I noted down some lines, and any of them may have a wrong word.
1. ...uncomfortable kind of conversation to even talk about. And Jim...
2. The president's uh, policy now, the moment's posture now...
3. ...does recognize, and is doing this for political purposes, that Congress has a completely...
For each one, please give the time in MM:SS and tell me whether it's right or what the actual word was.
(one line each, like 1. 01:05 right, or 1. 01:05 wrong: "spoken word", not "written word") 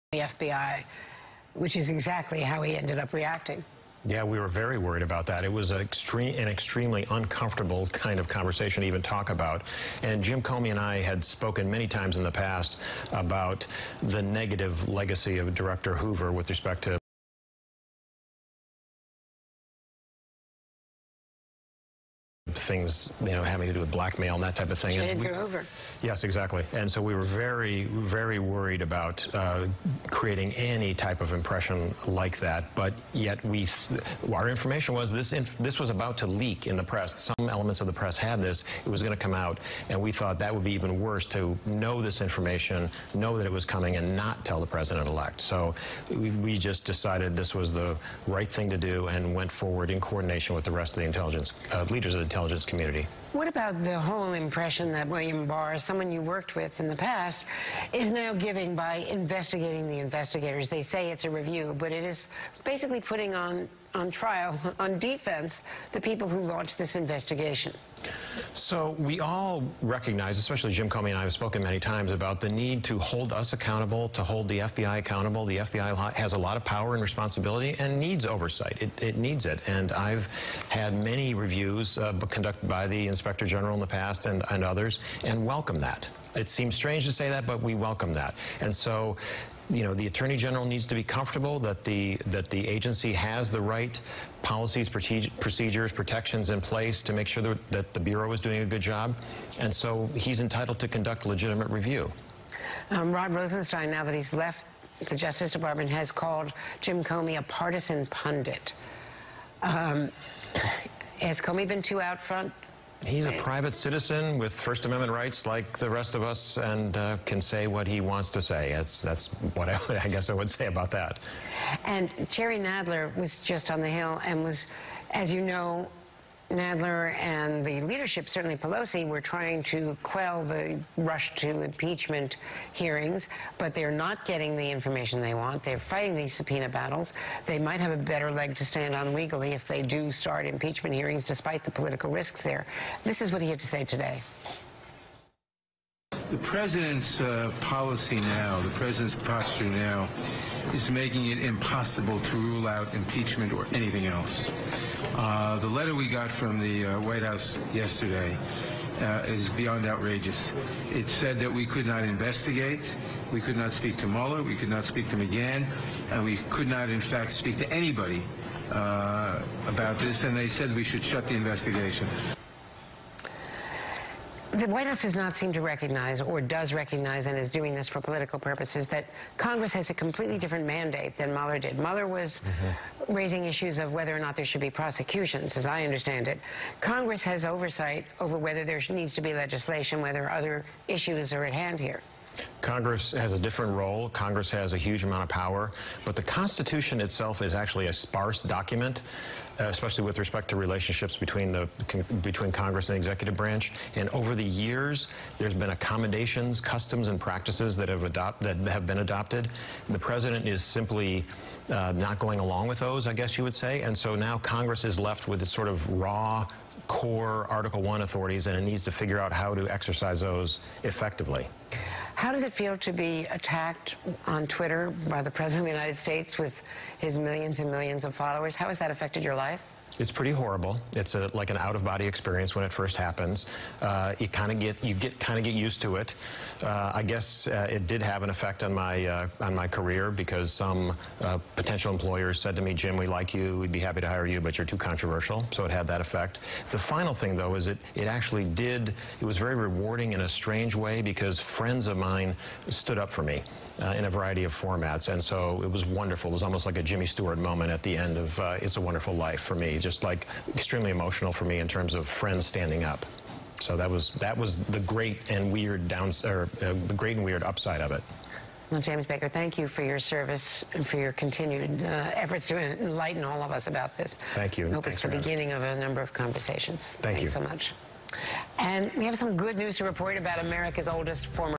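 1. 00:07 right
2. 02:26 wrong: "president", not "moment"
3. 02:56 right.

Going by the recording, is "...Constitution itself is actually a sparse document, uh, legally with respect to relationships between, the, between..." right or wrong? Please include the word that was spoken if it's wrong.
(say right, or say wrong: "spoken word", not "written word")
wrong: "especially", not "legally".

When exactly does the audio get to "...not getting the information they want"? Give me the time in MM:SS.
02:13.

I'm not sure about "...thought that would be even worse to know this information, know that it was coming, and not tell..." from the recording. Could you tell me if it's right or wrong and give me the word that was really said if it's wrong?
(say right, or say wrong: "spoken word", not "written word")
right.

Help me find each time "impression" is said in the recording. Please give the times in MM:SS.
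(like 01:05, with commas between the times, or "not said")
00:31, 00:54.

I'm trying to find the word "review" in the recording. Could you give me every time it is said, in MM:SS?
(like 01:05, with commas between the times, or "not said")
01:01, 01:21, 01:41.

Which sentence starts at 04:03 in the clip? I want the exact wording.
We'd be happy to hire you, but you're too controversial." So it had that effect.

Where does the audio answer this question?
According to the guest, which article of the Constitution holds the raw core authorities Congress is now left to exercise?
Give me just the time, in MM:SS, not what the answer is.
03:37.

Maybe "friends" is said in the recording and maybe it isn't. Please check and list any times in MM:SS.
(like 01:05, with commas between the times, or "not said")
04:11, 04:22.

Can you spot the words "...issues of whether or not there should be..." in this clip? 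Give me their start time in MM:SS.
03:03.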